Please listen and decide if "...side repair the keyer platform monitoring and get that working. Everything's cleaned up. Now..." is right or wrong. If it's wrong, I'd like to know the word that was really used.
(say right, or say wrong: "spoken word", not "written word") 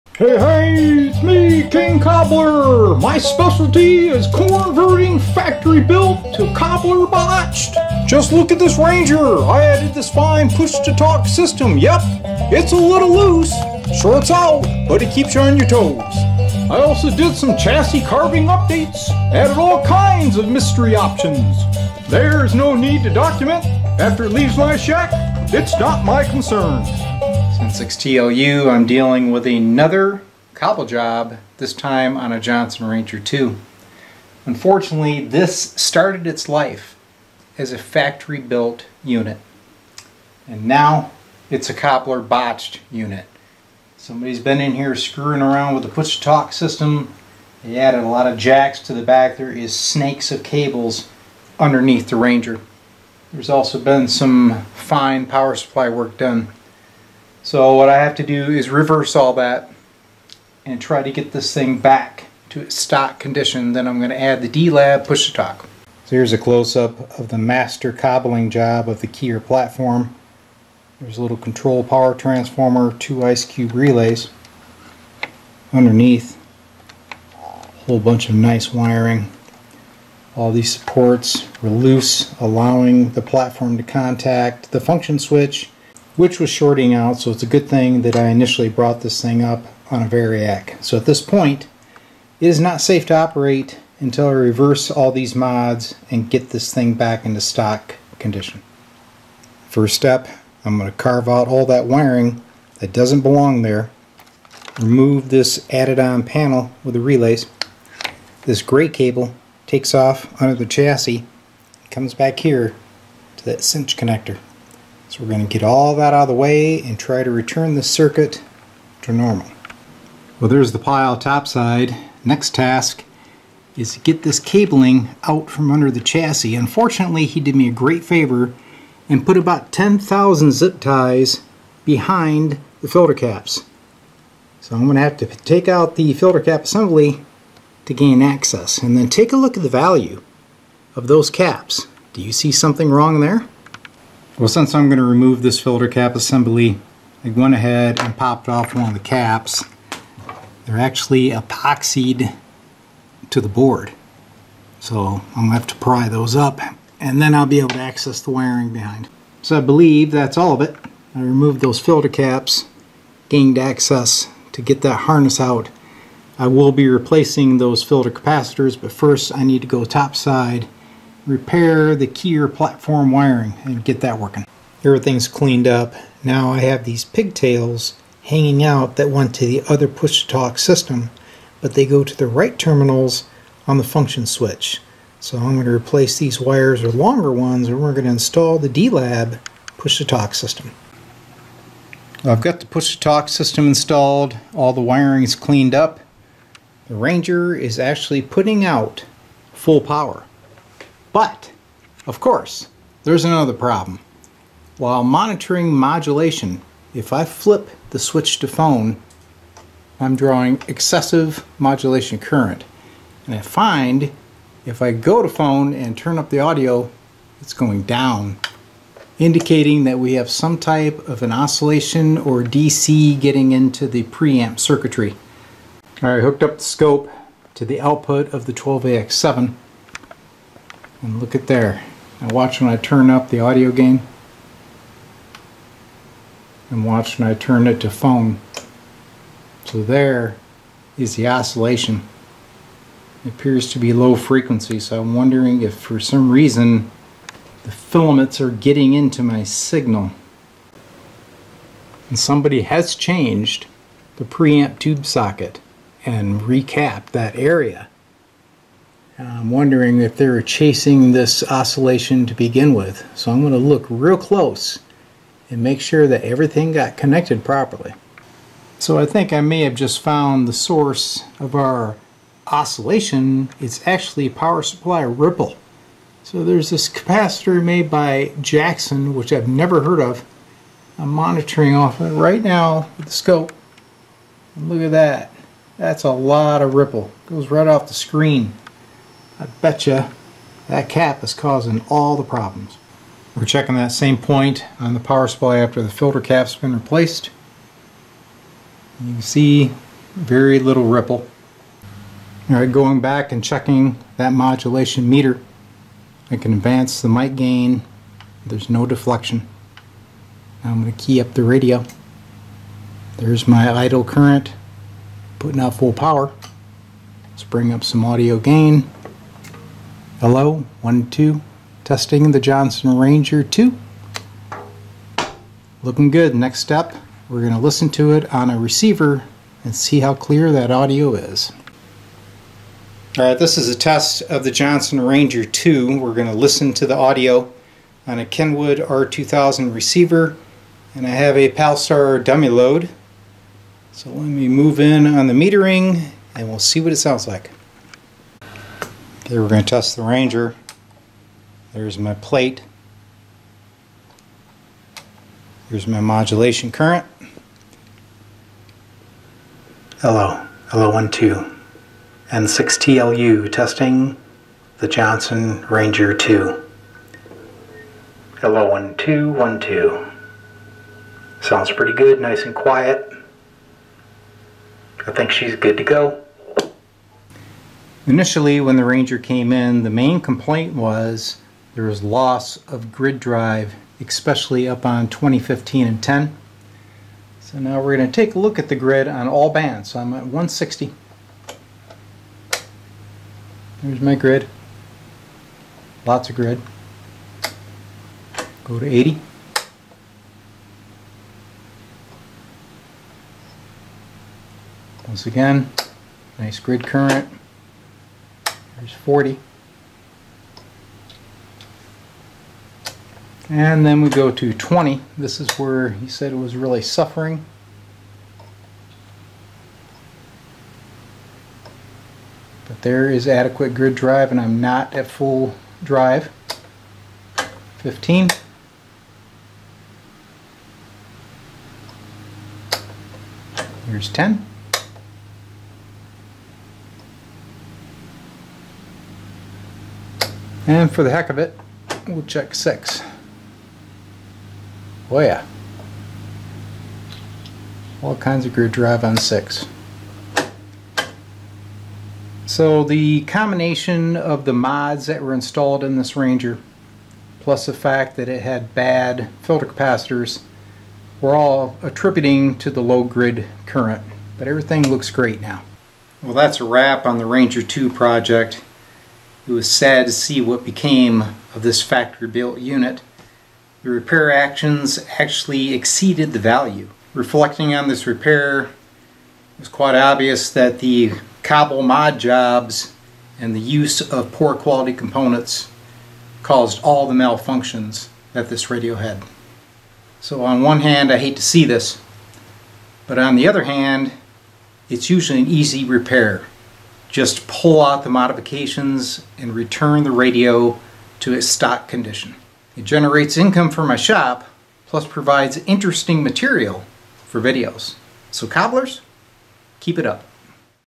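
wrong: "wiring", not "monitoring".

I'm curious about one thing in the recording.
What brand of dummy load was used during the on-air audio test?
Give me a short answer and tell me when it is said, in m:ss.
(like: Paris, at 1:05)
Palstar, at 5:41.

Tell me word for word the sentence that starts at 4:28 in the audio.
So I think I may have just found the source of our oscillation.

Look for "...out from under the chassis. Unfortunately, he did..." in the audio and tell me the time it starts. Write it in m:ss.
2:05.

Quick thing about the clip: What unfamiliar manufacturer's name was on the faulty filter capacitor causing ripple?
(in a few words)
Jackson.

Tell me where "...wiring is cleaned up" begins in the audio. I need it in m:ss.
3:14.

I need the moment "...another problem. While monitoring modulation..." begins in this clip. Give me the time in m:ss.
3:23.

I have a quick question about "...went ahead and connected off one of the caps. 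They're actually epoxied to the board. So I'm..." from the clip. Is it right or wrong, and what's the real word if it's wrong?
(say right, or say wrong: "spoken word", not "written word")
wrong: "popped", not "connected".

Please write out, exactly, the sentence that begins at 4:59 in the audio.
You can see very little ripple.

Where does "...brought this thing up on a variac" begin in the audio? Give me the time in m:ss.
1:28.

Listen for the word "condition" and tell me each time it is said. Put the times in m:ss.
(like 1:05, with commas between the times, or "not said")
1:03, 1:38, 8:21.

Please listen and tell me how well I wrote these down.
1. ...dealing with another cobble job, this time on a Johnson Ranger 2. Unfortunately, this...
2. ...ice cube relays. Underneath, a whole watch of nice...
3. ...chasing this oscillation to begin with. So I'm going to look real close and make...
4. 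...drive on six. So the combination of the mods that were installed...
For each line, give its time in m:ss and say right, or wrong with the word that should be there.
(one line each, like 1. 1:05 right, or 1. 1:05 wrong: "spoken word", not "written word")
1. 0:28 right
2. 1:13 wrong: "bunch", not "watch"
3. 4:20 right
4. 7:28 right.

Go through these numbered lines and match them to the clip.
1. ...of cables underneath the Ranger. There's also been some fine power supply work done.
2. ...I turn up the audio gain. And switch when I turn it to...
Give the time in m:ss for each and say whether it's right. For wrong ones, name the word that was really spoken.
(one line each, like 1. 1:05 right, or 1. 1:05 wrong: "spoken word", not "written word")
1. 0:50 right
2. 3:52 wrong: "watch", not "switch".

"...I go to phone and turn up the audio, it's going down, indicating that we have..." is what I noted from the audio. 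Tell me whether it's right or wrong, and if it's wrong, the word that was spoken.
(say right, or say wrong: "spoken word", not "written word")
right.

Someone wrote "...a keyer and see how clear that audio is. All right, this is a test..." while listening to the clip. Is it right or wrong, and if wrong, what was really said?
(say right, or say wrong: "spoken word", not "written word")
wrong: "receiver", not "keyer".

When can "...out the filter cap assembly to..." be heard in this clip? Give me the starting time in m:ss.
2:15.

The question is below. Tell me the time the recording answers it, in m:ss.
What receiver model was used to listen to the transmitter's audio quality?
5:38.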